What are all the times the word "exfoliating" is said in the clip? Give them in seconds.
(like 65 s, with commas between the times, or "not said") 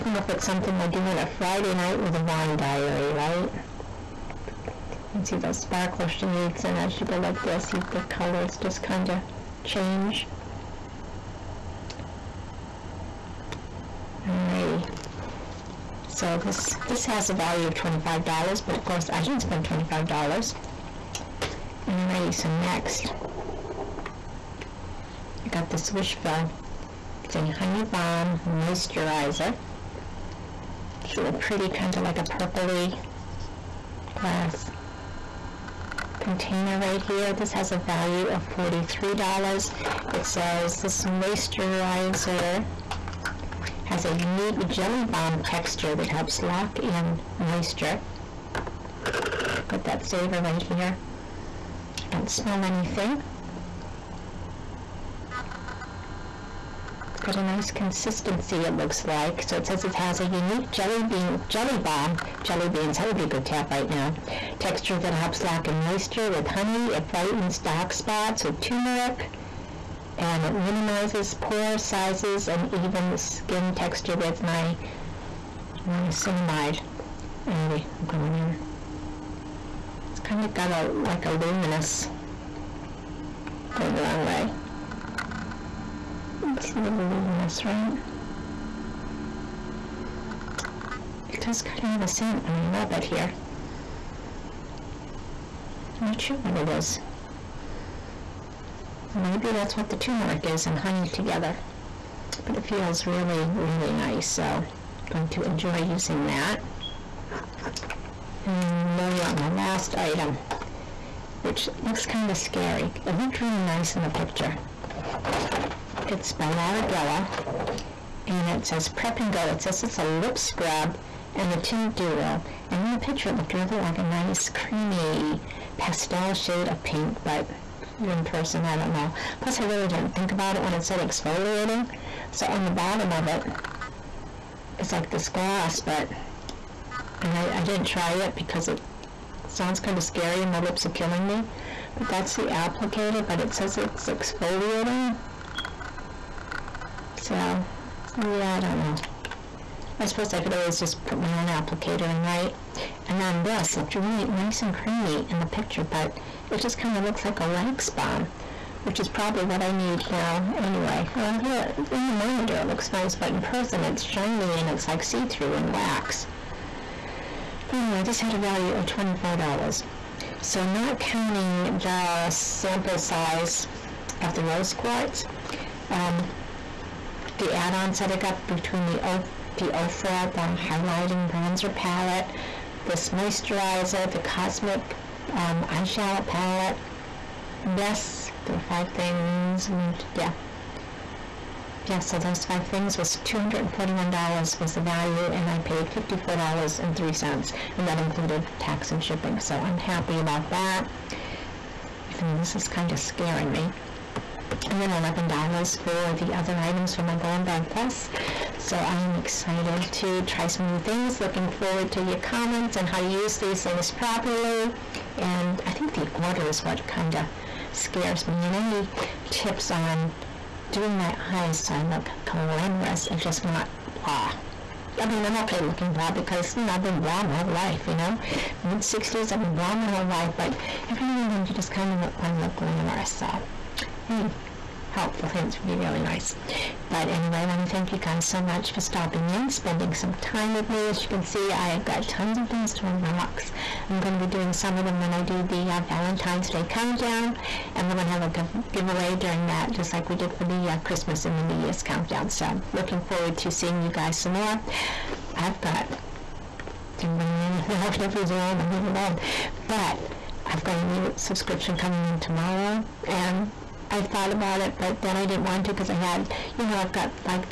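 131 s, 144 s.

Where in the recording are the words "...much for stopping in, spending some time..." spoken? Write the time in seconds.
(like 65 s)
238 s.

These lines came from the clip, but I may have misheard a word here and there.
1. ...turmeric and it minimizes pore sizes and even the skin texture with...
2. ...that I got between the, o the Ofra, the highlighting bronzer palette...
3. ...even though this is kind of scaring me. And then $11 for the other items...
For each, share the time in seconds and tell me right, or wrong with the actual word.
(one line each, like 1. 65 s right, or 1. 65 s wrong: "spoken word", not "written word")
1. 68 s right
2. 177 s right
3. 202 s right.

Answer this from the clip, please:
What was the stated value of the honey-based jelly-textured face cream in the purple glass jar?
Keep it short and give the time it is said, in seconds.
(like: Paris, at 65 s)
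$43, at 38 s.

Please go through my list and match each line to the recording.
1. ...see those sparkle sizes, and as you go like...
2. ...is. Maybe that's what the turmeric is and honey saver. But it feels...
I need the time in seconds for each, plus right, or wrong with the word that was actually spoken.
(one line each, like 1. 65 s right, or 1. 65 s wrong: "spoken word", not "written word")
1. 5 s wrong: "shades", not "sizes"
2. 96 s wrong: "together", not "saver".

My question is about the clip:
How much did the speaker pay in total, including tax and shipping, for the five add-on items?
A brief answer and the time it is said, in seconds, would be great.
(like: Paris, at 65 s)
$54.03, at 195 s.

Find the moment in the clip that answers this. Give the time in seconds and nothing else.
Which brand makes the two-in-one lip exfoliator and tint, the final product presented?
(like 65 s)
116 s.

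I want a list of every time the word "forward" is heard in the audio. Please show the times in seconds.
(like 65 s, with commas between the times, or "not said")
211 s, 253 s.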